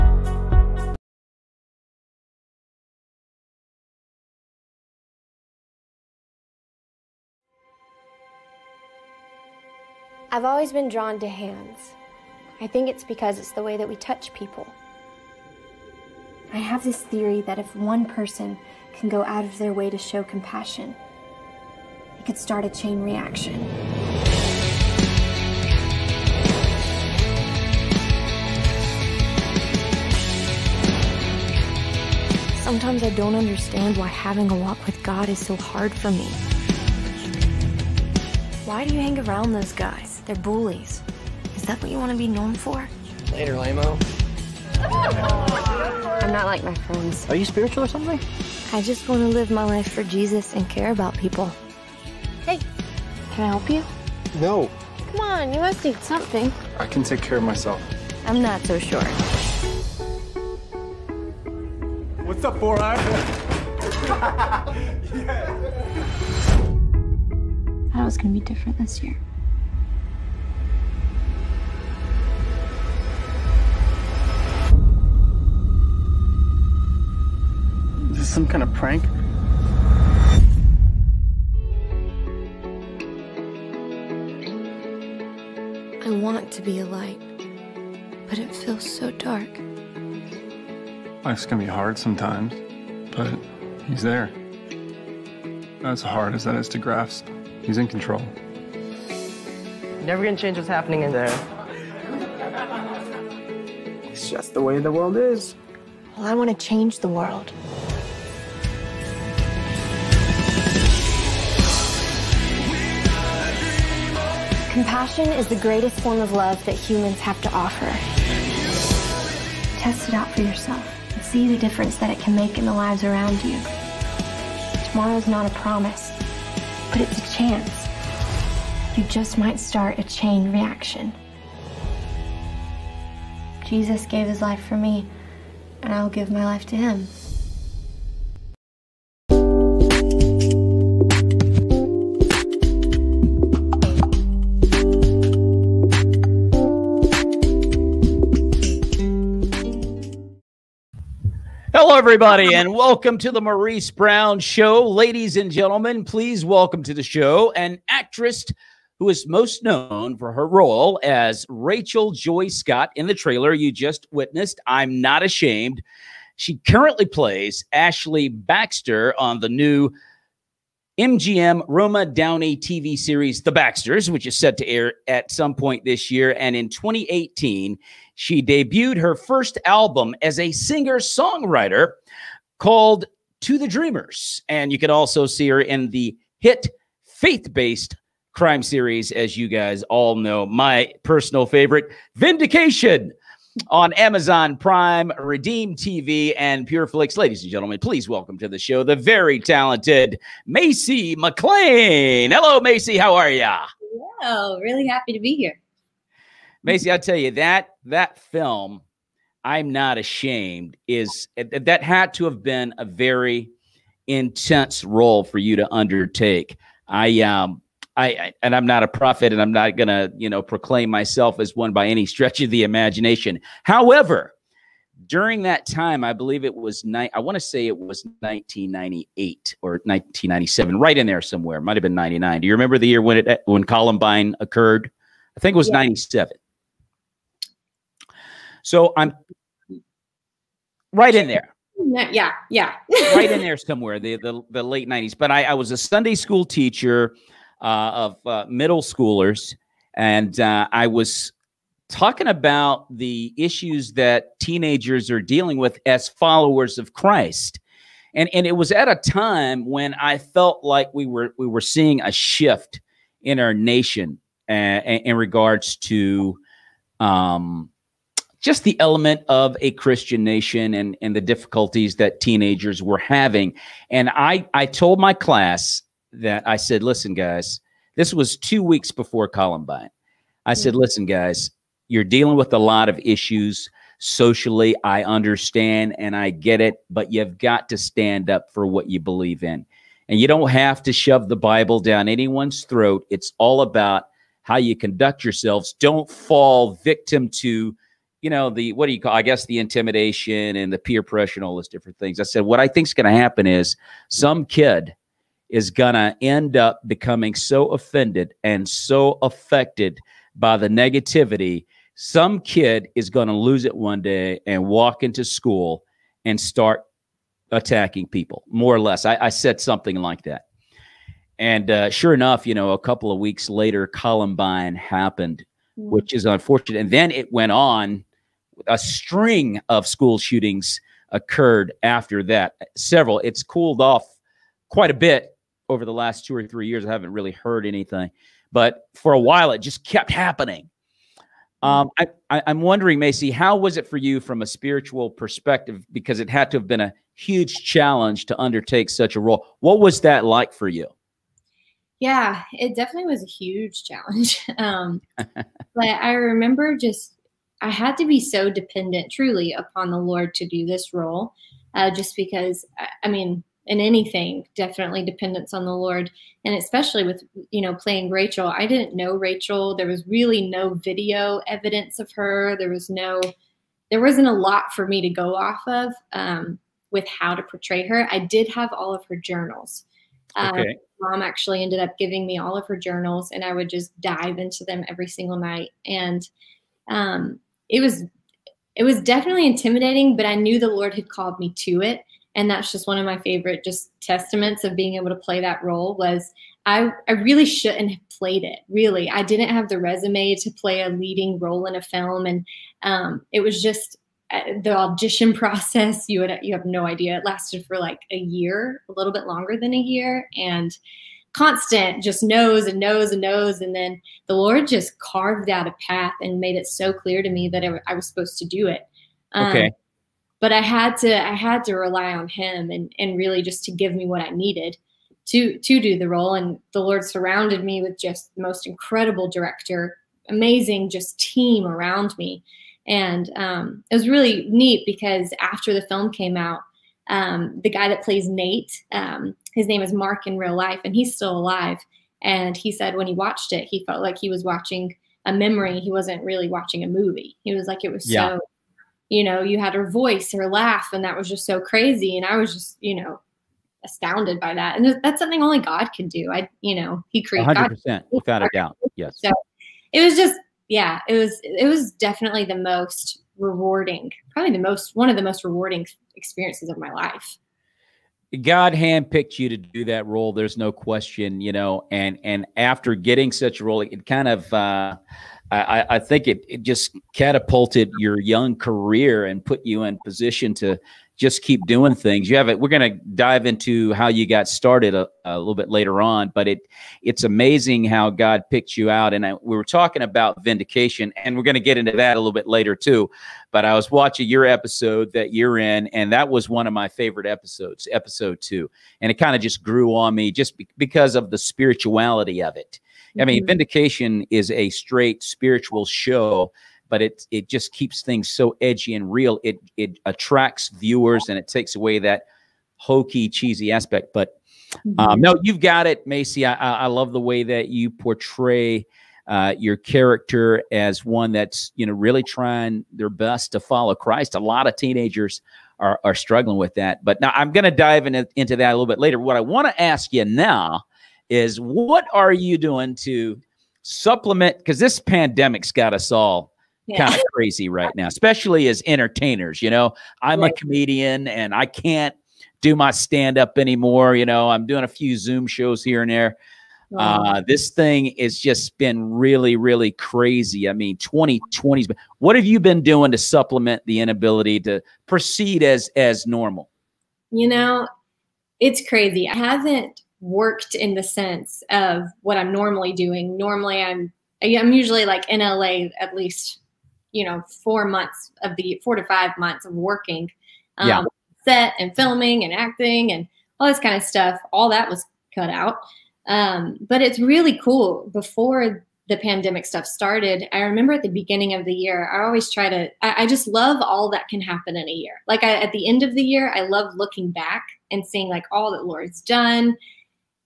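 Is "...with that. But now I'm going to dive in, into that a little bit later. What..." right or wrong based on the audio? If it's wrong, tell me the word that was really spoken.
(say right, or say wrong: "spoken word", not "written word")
right.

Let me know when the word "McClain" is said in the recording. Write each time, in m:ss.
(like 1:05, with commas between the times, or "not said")
3:21.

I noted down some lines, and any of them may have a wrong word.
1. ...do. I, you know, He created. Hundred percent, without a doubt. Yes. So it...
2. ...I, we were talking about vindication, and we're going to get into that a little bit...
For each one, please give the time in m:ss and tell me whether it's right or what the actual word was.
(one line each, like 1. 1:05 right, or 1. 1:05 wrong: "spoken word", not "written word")
1. 7:36 right
2. 8:09 right.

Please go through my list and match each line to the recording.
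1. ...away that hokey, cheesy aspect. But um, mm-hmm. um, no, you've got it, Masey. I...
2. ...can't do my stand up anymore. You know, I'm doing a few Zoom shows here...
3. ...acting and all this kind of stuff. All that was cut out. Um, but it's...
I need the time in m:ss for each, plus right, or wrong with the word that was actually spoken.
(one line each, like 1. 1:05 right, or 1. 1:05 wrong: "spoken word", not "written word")
1. 8:31 right
2. 9:01 right
3. 9:32 right.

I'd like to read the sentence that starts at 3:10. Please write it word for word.
My personal favorite, Vindication on Amazon Prime, Redeem TV, and PureFlix.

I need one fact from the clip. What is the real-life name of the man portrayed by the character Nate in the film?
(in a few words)
Mark.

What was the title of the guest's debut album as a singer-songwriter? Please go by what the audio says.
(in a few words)
To the Dreamers.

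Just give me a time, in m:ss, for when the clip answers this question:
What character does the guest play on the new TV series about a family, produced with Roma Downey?
2:47.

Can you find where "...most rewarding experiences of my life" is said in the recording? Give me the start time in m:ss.
7:45.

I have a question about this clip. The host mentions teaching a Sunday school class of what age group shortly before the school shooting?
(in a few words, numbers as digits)
Middle schoolers.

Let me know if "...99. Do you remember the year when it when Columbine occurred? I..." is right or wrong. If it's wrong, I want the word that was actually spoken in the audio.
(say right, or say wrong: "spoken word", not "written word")
right.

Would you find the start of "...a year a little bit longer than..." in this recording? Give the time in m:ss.
6:48.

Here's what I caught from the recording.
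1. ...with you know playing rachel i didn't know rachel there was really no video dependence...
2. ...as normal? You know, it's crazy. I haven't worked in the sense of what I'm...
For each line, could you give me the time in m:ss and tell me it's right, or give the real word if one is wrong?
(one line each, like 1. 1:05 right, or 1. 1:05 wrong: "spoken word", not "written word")
1. 6:07 wrong: "evidence", not "dependence"
2. 9:15 right.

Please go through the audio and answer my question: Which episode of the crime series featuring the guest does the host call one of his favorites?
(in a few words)
Episode 2.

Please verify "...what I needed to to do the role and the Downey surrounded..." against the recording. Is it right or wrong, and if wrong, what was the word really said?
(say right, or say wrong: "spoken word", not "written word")
wrong: "Lord", not "Downey".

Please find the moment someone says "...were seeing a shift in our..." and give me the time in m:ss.
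4:21.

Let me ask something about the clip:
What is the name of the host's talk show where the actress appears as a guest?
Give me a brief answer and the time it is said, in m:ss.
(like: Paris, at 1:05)
The Maurice Brown Show, at 2:33.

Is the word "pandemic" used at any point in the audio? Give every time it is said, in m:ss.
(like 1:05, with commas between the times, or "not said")
8:54, 9:39.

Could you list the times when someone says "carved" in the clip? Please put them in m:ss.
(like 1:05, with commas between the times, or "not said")
6:54.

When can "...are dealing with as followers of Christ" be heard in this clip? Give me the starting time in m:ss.
4:15.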